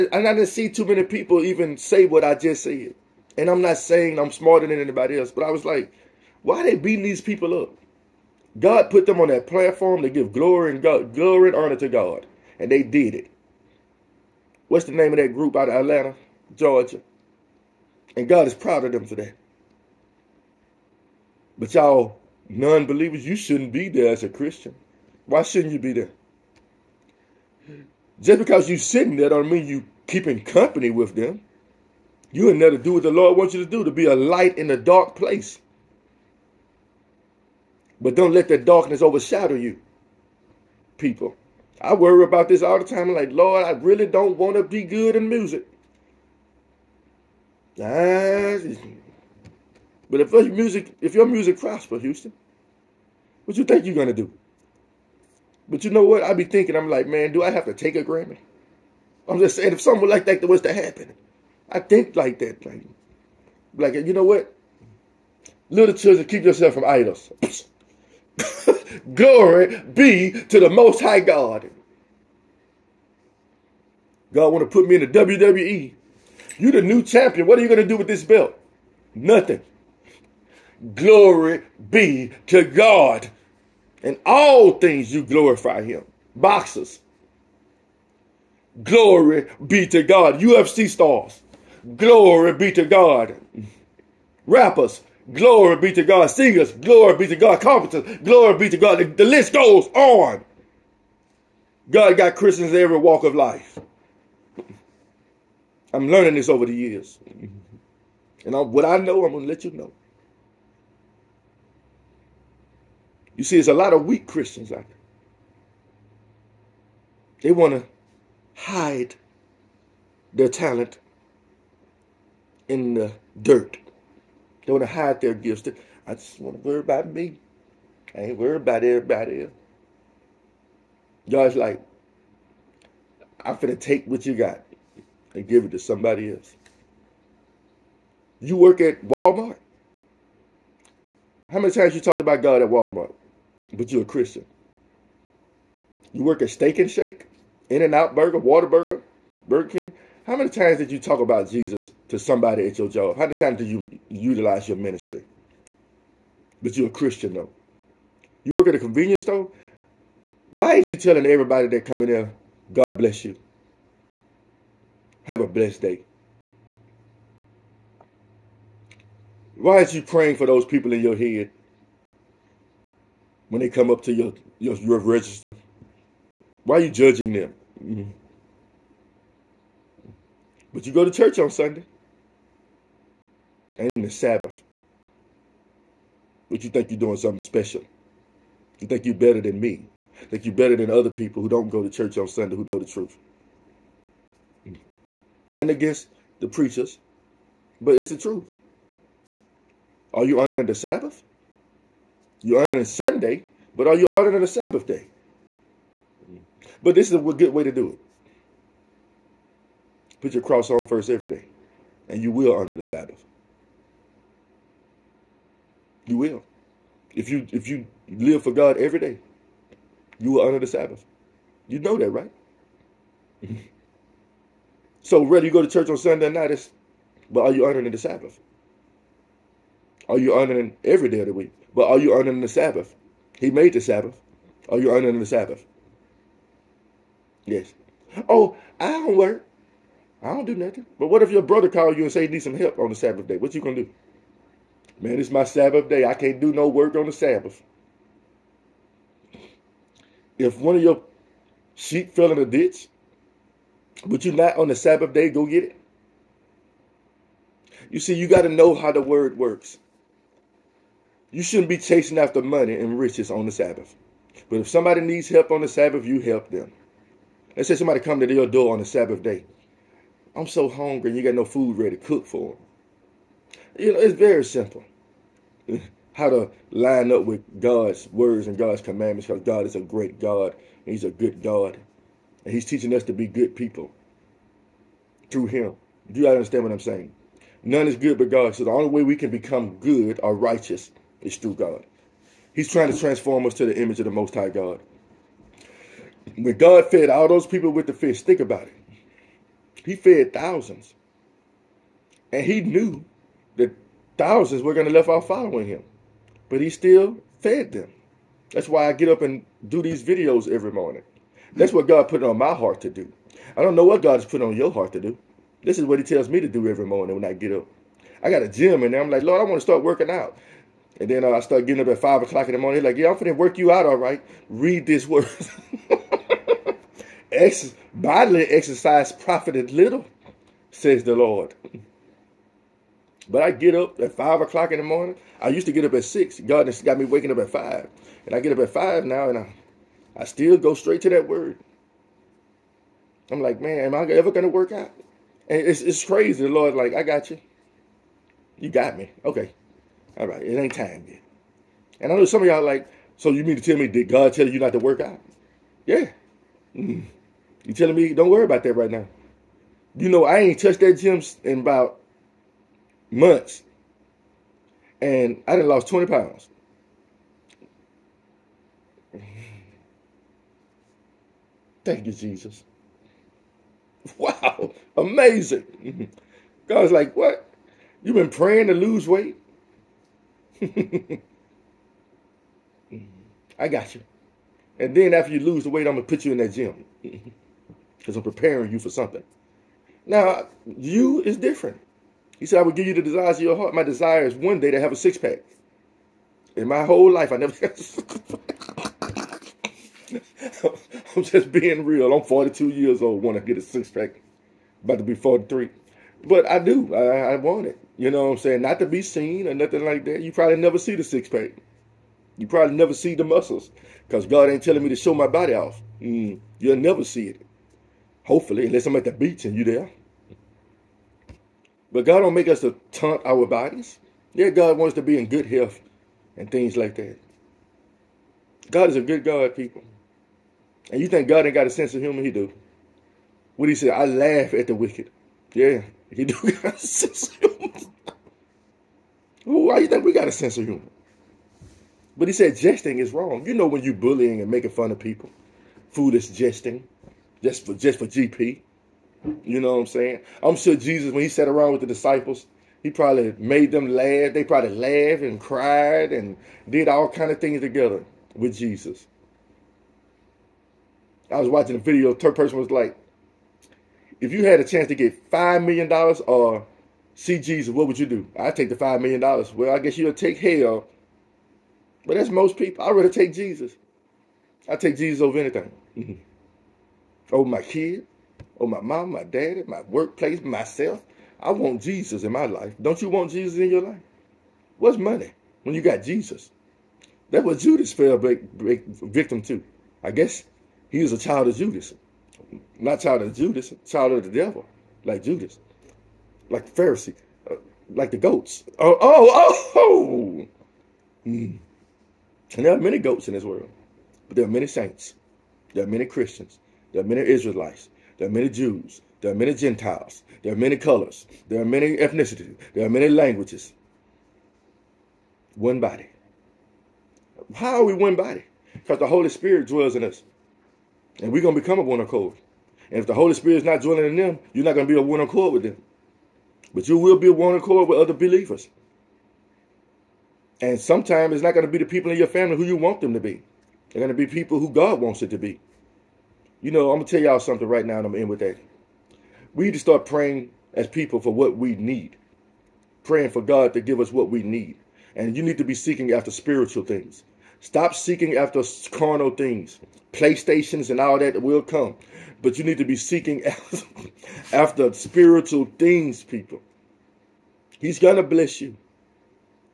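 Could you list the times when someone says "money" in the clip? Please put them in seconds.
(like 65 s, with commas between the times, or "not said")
262 s, 484 s.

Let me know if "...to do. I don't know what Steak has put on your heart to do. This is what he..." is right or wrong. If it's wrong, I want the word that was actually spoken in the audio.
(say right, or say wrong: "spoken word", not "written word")
wrong: "God", not "Steak".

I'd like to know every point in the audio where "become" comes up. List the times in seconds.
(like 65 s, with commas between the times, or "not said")
289 s, 521 s.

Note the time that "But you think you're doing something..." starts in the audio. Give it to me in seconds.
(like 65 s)
186 s.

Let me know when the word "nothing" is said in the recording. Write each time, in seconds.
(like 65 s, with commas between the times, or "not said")
79 s, 240 s, 409 s.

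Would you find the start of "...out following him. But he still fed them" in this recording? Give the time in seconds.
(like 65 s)
305 s.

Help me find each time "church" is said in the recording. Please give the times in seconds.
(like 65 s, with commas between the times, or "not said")
181 s, 191 s, 225 s.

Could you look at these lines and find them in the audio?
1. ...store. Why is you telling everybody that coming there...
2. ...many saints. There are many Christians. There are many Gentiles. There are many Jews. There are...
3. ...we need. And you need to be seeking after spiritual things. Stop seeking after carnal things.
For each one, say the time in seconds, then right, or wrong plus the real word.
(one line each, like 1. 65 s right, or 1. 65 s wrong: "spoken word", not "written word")
1. 159 s right
2. 504 s wrong: "Israelites", not "Gentiles"
3. 544 s right.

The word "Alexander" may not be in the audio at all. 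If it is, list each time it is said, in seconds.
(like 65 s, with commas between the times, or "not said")
not said.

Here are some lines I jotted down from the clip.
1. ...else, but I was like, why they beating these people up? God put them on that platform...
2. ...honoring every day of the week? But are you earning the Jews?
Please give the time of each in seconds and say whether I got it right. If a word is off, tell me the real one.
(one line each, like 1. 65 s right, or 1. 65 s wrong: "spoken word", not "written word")
1. 5 s right
2. 230 s wrong: "Sabbath", not "Jews".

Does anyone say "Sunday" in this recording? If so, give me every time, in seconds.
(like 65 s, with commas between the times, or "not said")
181 s, 192 s, 202 s, 225 s.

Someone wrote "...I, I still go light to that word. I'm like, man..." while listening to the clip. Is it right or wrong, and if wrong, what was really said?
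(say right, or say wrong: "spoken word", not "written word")
wrong: "straight", not "light".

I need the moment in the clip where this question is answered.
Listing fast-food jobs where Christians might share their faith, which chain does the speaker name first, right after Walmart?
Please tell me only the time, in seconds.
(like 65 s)
146 s.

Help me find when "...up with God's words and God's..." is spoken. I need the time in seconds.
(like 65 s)
277 s.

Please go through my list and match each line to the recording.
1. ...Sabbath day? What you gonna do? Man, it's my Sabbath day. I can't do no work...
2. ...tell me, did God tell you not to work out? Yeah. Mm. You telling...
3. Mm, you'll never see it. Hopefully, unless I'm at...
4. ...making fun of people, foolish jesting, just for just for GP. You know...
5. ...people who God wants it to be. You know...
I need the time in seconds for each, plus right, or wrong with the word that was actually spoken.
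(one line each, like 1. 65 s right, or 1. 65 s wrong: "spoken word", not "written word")
1. 242 s right
2. 353 s right
3. 416 s right
4. 444 s right
5. 534 s right.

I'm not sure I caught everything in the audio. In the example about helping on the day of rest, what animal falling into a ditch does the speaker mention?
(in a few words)
Sheep.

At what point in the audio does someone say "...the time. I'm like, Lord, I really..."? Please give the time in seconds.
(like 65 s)
42 s.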